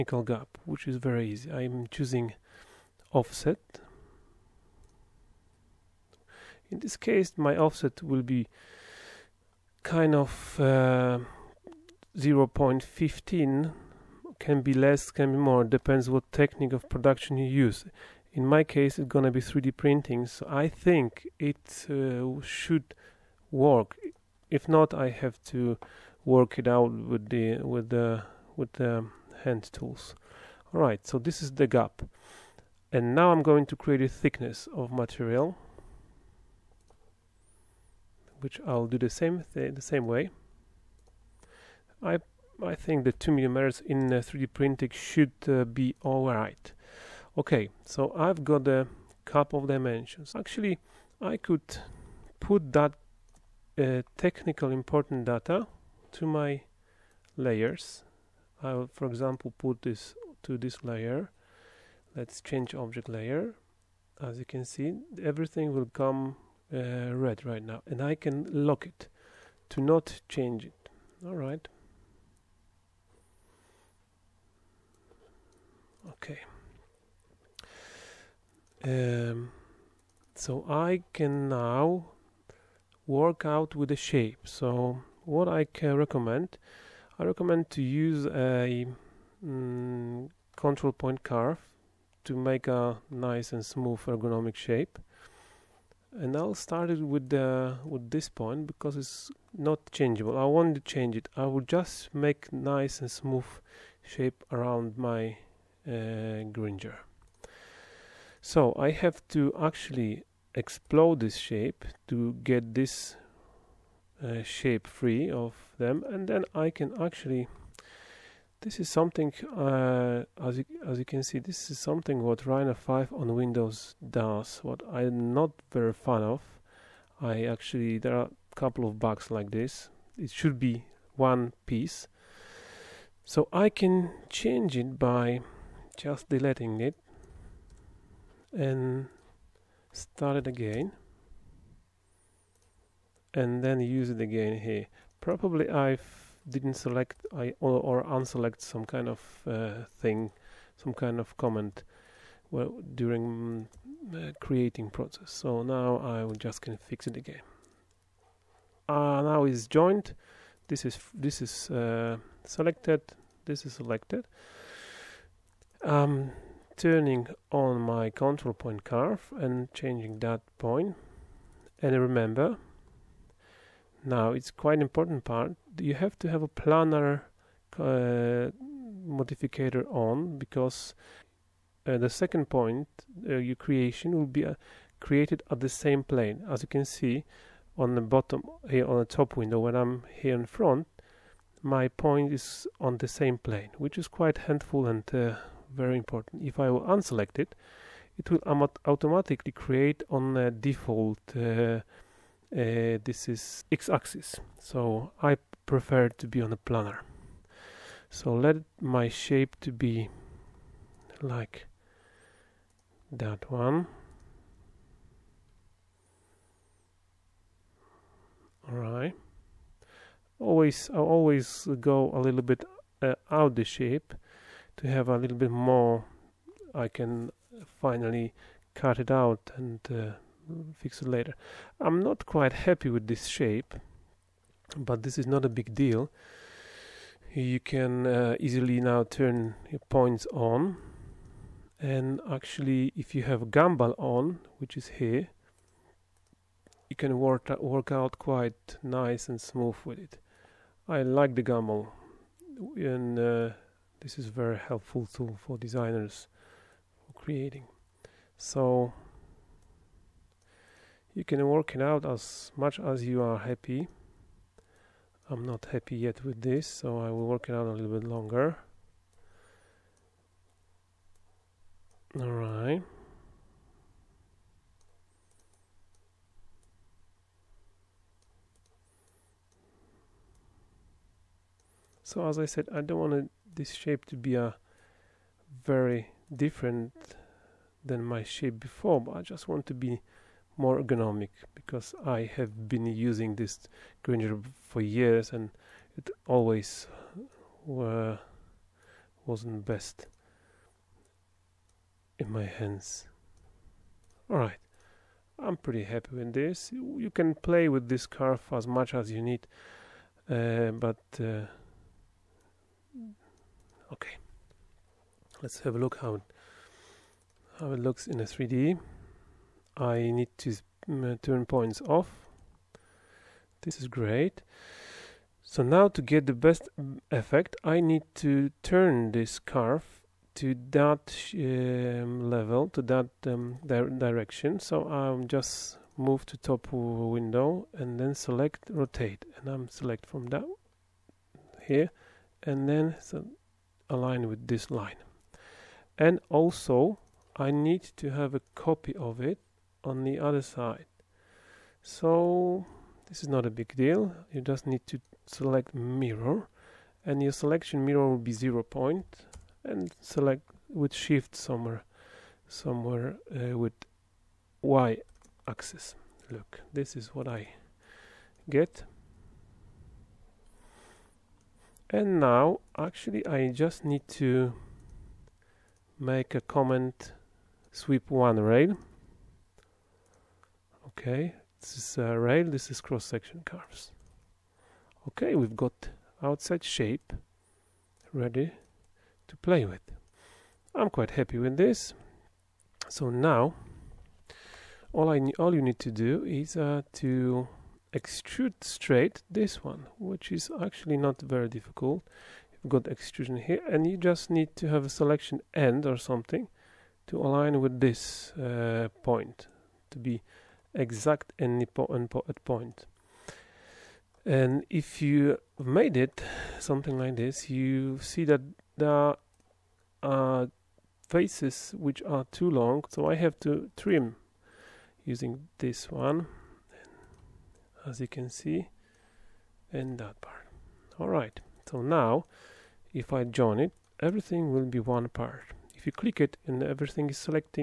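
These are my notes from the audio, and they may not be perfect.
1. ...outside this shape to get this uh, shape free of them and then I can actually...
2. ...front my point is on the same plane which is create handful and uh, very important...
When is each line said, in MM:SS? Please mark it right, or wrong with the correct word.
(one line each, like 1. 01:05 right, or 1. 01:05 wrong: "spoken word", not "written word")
1. 01:50 wrong: "explode", not "outside"
2. 03:10 wrong: "quite", not "create".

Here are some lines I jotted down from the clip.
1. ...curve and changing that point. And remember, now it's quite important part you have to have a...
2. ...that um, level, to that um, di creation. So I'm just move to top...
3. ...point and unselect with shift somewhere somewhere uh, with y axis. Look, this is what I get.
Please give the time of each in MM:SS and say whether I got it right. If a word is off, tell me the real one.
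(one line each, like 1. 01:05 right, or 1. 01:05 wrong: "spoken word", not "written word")
1. 02:48 right
2. 05:30 wrong: "direction", not "creation"
3. 05:58 wrong: "select", not "unselect".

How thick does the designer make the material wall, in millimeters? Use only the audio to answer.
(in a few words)
2 millimeters.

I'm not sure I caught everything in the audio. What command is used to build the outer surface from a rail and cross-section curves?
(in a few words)
Sweep one rail.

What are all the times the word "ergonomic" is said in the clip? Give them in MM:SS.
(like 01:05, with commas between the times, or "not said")
01:34, 04:50.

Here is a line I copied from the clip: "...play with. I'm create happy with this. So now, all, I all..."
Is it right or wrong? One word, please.
wrong.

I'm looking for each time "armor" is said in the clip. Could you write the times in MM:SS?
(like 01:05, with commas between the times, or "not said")
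not said.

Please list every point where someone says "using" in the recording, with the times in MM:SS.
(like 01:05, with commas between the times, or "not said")
04:52, 07:05.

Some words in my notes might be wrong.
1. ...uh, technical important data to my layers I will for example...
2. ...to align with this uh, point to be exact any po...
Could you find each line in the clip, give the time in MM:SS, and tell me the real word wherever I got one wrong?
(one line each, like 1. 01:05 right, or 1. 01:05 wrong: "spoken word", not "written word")
1. 00:53 right
2. 06:47 right.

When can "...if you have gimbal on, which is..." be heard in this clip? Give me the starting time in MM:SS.
04:02.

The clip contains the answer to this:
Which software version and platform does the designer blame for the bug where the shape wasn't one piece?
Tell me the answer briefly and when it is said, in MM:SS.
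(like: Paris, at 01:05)
Rhino 5 on Windows, at 02:02.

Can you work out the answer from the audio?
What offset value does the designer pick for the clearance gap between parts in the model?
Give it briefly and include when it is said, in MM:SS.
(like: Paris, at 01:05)
0.15, at 00:12.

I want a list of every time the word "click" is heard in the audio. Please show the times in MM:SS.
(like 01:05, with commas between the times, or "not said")
07:15.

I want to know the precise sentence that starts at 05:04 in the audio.
Alright, I'm pretty happy with this.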